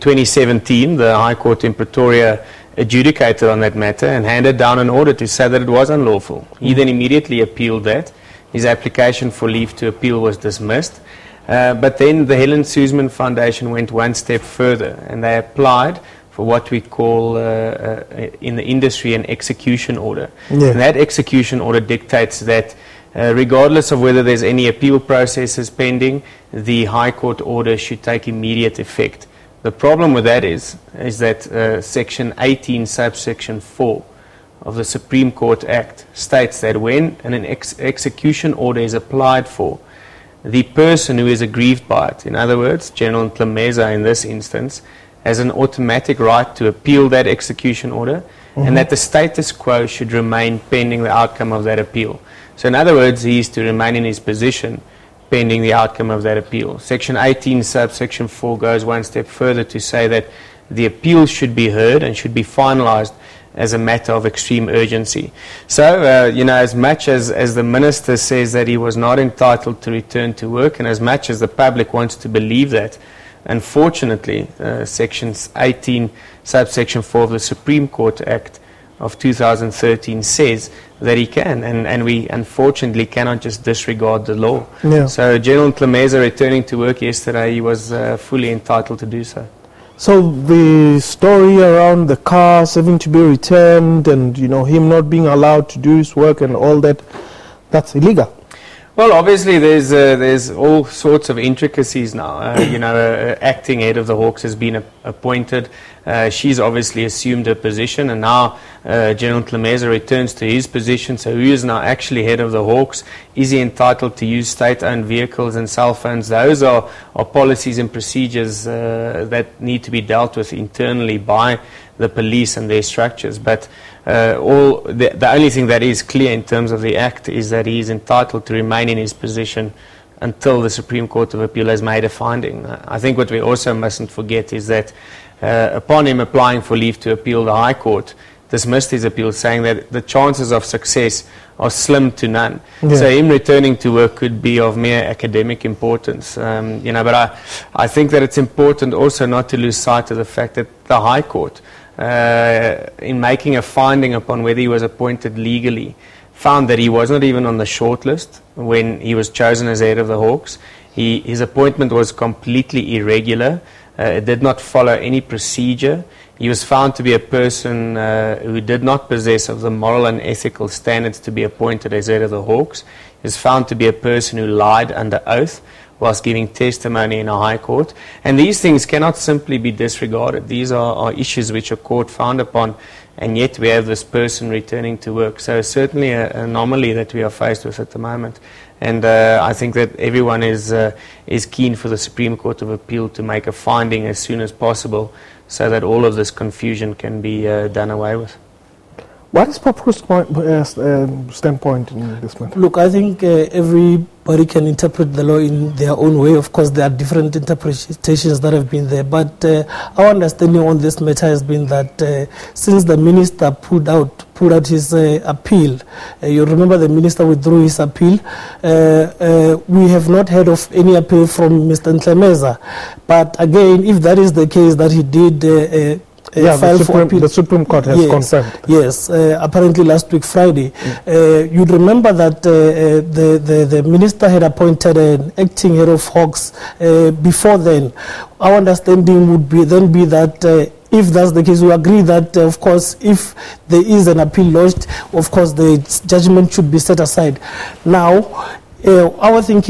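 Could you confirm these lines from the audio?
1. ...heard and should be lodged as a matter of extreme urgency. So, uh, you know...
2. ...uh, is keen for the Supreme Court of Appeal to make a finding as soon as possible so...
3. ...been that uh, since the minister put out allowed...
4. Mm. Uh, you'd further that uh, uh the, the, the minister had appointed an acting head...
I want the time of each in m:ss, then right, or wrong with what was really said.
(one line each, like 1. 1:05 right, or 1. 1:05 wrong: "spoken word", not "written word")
1. 1:01 wrong: "finalized", not "lodged"
2. 3:10 right
3. 3:31 wrong: "pulled", not "allowed"
4. 3:50 wrong: "remember", not "further".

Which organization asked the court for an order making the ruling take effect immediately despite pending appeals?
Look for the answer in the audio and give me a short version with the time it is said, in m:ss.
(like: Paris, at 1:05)
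Helen Suzman Foundation, at 0:12.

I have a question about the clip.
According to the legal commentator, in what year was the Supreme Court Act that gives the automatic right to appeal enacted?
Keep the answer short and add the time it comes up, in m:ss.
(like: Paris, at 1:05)
2013, at 1:19.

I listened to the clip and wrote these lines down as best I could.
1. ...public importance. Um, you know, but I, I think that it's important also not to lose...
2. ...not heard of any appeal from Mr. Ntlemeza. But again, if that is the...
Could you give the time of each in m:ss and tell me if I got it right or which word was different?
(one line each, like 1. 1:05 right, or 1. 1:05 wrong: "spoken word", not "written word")
1. 2:25 wrong: "academic", not "public"
2. 3:40 right.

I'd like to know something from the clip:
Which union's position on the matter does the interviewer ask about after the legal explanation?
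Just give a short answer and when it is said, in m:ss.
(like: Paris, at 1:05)
Popcru, at 3:19.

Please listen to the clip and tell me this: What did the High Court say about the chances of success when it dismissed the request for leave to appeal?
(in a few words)
slim to none.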